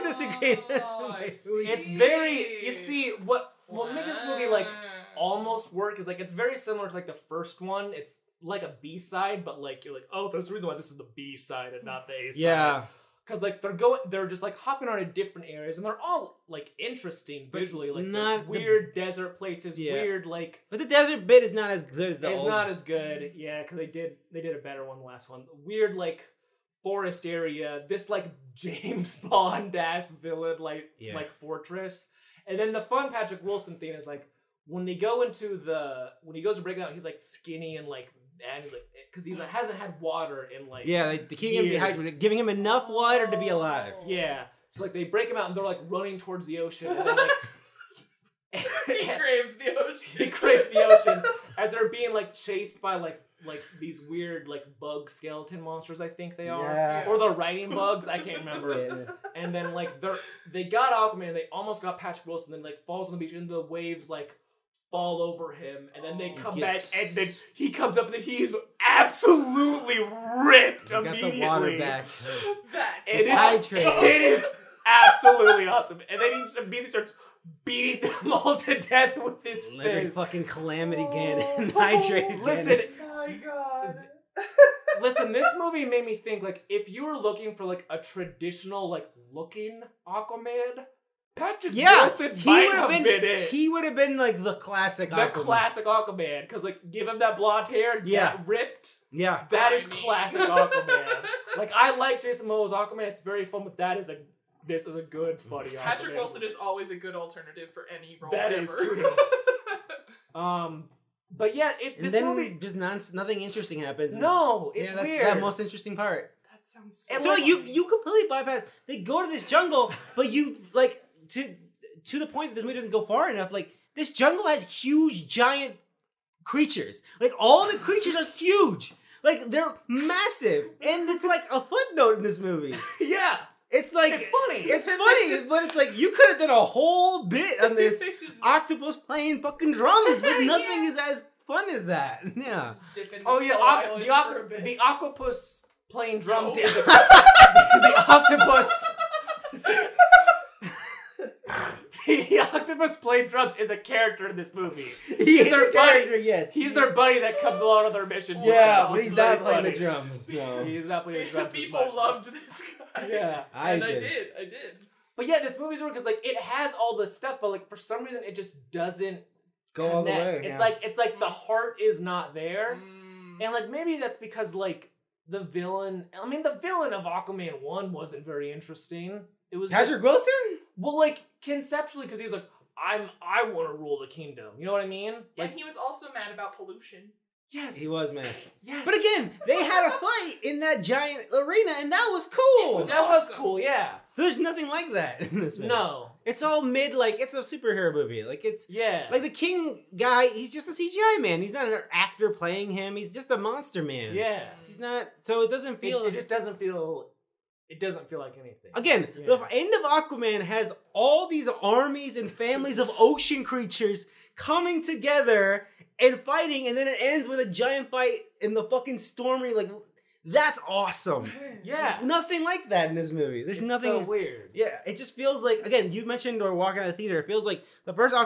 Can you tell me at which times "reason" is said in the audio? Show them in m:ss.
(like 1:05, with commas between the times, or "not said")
0:10, 2:48.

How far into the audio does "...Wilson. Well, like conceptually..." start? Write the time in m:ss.
3:00.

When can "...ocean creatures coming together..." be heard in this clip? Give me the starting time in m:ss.
3:32.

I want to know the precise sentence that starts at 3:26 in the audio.
It, it just doesn't feel it doesn't feel like anything.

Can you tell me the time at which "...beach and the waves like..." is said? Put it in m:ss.
1:03.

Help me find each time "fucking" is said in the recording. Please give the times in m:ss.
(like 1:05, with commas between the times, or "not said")
1:20, 2:19, 3:38.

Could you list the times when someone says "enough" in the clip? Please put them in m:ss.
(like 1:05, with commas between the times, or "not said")
0:42, 2:03.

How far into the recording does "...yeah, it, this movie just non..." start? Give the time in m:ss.
1:51.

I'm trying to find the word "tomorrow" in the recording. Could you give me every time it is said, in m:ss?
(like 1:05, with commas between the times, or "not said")
not said.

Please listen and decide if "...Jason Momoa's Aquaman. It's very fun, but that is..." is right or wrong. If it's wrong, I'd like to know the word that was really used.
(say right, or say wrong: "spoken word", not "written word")
right.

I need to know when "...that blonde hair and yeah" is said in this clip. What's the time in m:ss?
1:37.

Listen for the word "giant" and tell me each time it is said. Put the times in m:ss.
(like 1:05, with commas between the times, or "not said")
2:05, 3:10, 3:37.